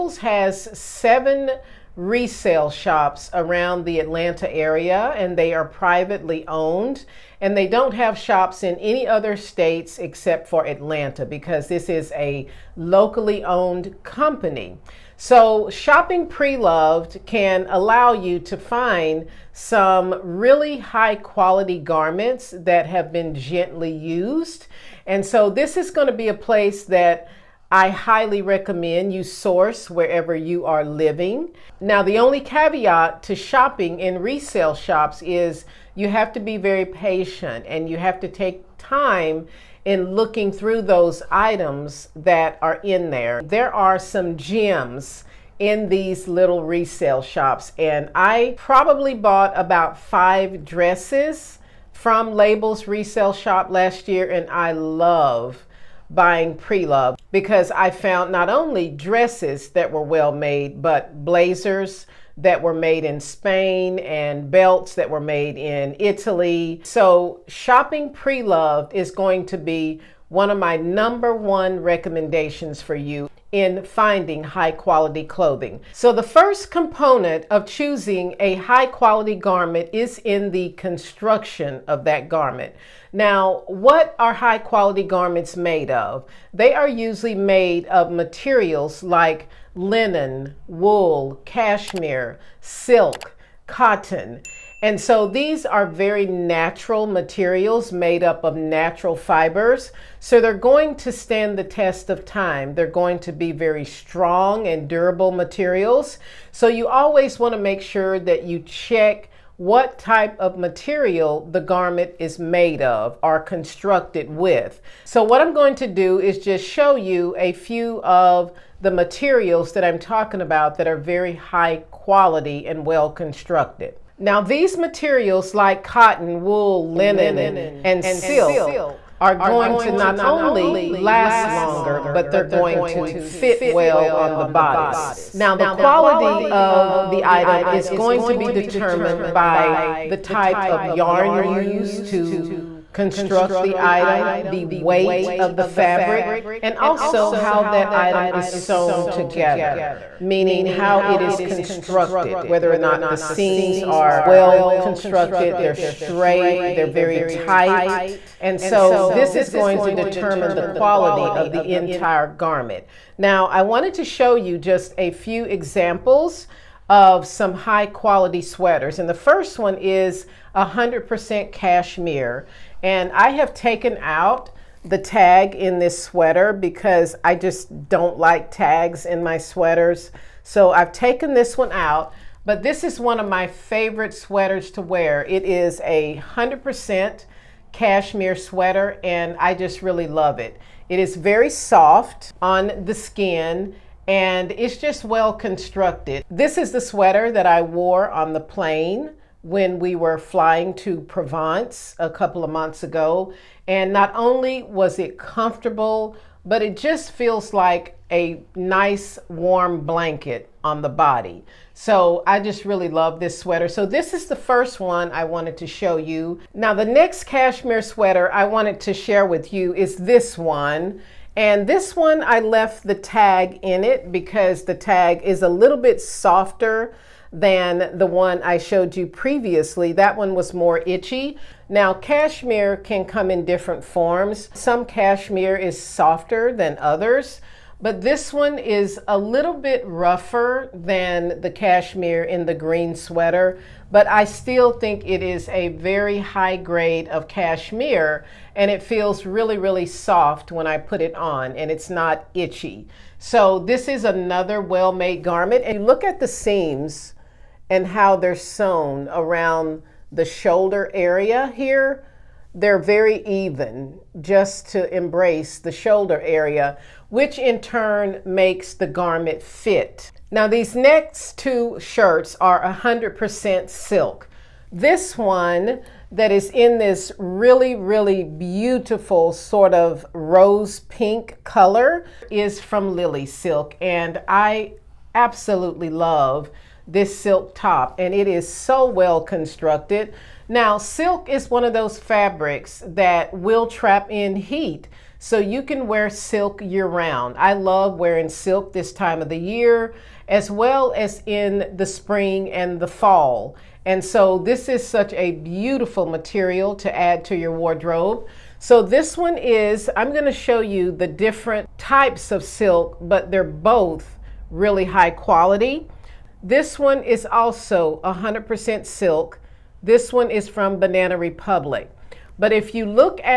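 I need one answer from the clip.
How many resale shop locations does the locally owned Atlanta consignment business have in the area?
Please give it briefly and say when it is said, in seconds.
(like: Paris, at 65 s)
7, at 0 s.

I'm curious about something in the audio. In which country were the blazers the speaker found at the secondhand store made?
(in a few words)
Spain.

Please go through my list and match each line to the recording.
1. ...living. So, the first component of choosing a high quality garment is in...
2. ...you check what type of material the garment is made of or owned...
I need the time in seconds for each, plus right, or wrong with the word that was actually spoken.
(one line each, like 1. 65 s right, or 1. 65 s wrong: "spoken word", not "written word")
1. 75 s wrong: "clothing", not "living"
2. 108 s wrong: "constructed", not "owned".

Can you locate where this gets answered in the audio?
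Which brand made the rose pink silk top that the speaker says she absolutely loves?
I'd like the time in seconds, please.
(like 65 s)
282 s.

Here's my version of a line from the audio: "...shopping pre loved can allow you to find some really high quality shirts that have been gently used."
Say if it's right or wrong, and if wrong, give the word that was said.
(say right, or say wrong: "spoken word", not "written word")
wrong: "garments", not "shirts".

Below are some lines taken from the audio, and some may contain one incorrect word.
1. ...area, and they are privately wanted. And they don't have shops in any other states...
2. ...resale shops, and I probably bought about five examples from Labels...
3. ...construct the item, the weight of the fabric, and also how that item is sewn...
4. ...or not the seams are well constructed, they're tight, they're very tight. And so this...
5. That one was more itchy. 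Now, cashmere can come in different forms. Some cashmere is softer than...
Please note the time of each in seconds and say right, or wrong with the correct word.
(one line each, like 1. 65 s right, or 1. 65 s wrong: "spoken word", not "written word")
1. 4 s wrong: "owned", not "wanted"
2. 46 s wrong: "dresses", not "examples"
3. 142 s right
4. 152 s wrong: "straight", not "tight"
5. 229 s right.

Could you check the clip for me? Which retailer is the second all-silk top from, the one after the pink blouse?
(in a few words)
Banana Republic.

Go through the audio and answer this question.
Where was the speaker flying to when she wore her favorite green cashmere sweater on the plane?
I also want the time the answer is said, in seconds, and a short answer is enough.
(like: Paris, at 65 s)
Provence, at 201 s.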